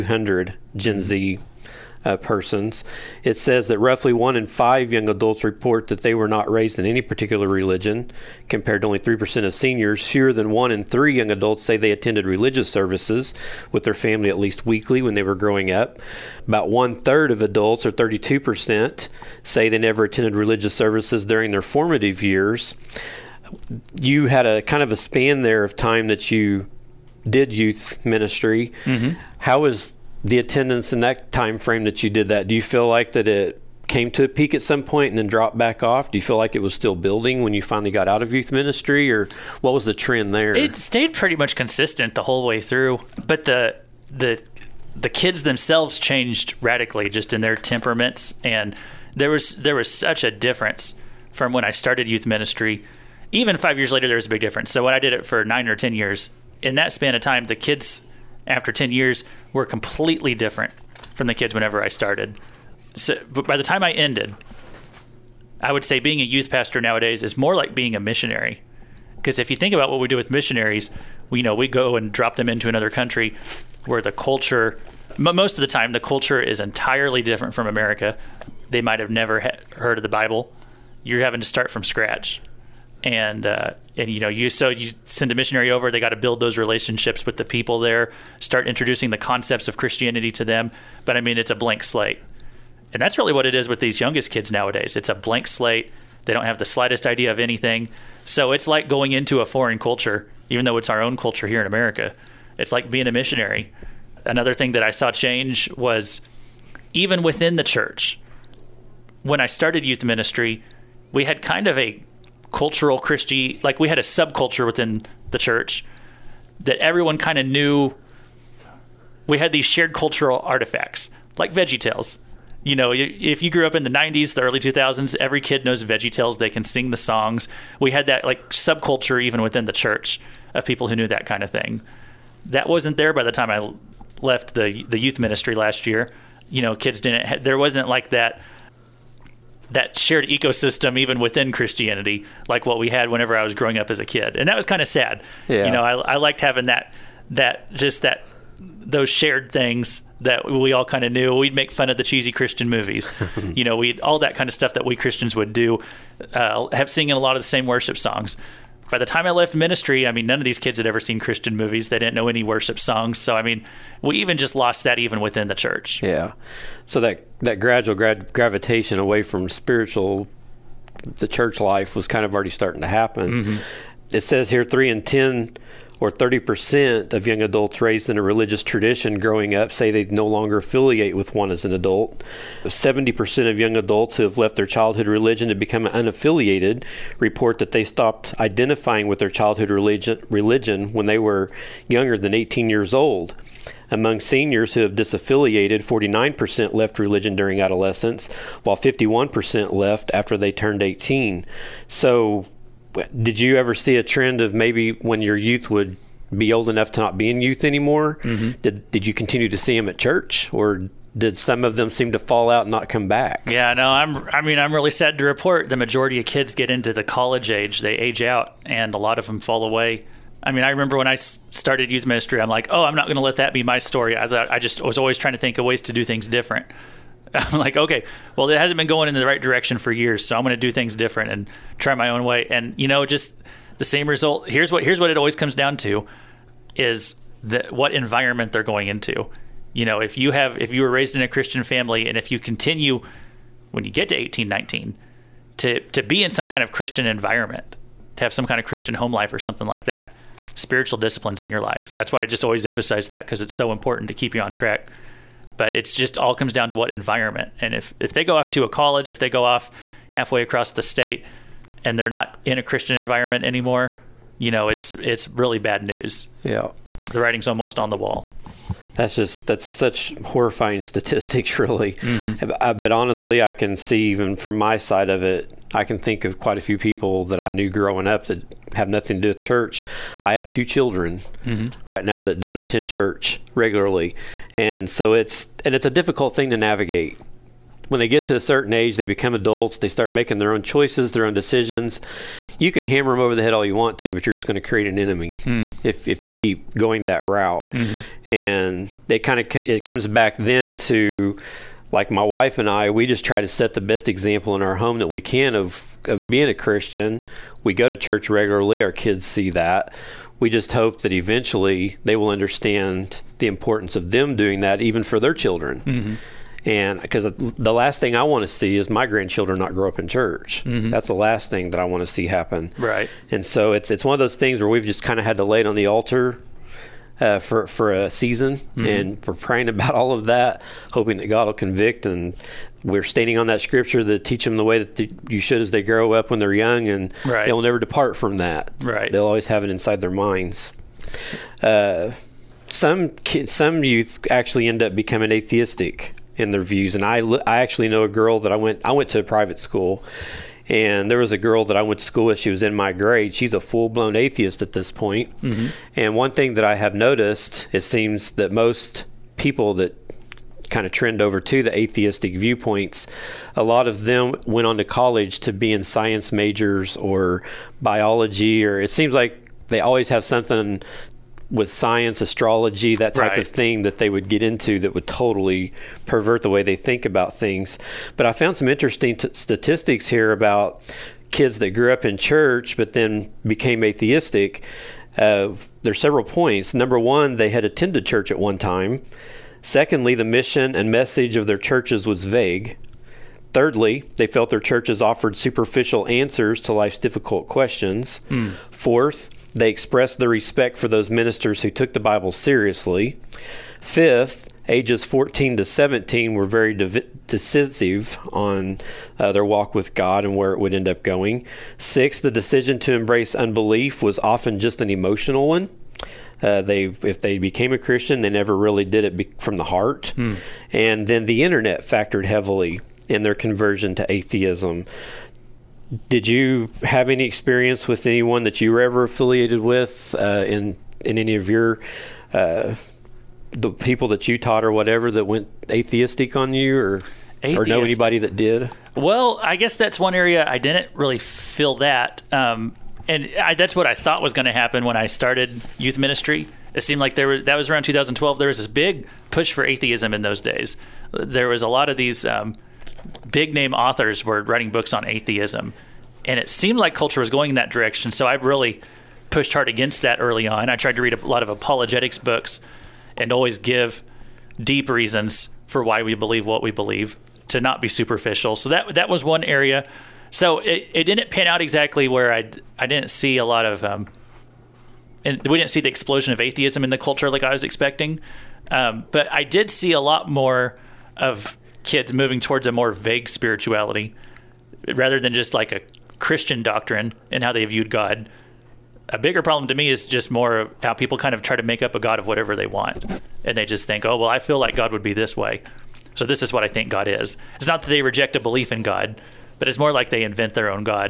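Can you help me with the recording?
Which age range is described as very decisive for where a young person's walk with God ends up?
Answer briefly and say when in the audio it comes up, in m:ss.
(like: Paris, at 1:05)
14 to 17, at 6:44.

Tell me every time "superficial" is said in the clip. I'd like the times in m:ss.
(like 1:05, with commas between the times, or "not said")
6:35, 7:47.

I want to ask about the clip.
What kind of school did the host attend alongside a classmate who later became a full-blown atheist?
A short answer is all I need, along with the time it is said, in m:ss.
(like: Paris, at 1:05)
private school, at 5:49.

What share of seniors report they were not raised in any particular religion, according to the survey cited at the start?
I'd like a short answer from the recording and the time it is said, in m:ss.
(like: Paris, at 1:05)
3%, at 0:08.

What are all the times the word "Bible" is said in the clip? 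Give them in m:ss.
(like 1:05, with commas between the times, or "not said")
1:20, 6:41.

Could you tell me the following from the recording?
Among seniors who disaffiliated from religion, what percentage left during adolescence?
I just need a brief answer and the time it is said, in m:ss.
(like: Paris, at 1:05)
49%, at 3:15.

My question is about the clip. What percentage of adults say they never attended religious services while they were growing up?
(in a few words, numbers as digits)
32%.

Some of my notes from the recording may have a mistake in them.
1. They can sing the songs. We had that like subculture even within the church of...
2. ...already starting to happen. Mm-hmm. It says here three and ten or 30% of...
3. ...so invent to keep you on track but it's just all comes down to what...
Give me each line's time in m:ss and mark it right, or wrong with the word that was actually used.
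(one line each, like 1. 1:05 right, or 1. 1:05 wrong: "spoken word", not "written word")
1. 2:06 right
2. 2:52 right
3. 4:13 wrong: "important", not "invent".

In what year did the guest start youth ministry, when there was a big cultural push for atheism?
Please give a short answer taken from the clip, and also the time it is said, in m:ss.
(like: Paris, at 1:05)
2012, at 7:27.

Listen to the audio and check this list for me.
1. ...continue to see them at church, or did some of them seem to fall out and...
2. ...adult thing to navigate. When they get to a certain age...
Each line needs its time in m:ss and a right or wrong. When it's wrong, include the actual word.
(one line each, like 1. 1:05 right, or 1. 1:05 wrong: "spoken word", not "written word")
1. 3:29 right
2. 4:45 wrong: "difficult", not "adult".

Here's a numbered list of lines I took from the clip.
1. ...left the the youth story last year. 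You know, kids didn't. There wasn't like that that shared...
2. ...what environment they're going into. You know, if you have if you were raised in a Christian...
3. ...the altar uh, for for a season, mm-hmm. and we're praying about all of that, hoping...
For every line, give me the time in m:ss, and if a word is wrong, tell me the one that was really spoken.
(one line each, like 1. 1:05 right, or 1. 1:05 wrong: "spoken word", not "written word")
1. 2:14 wrong: "ministry", not "story"
2. 3:57 right
3. 5:25 right.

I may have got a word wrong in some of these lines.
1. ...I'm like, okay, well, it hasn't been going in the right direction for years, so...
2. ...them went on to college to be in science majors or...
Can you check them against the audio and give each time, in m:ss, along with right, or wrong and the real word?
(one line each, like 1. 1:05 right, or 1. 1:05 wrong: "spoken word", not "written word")
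1. 3:47 right
2. 6:04 right.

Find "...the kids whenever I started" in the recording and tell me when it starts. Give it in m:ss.
1:01.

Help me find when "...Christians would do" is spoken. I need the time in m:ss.
2:34.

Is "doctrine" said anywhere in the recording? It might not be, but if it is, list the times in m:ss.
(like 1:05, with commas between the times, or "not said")
8:06.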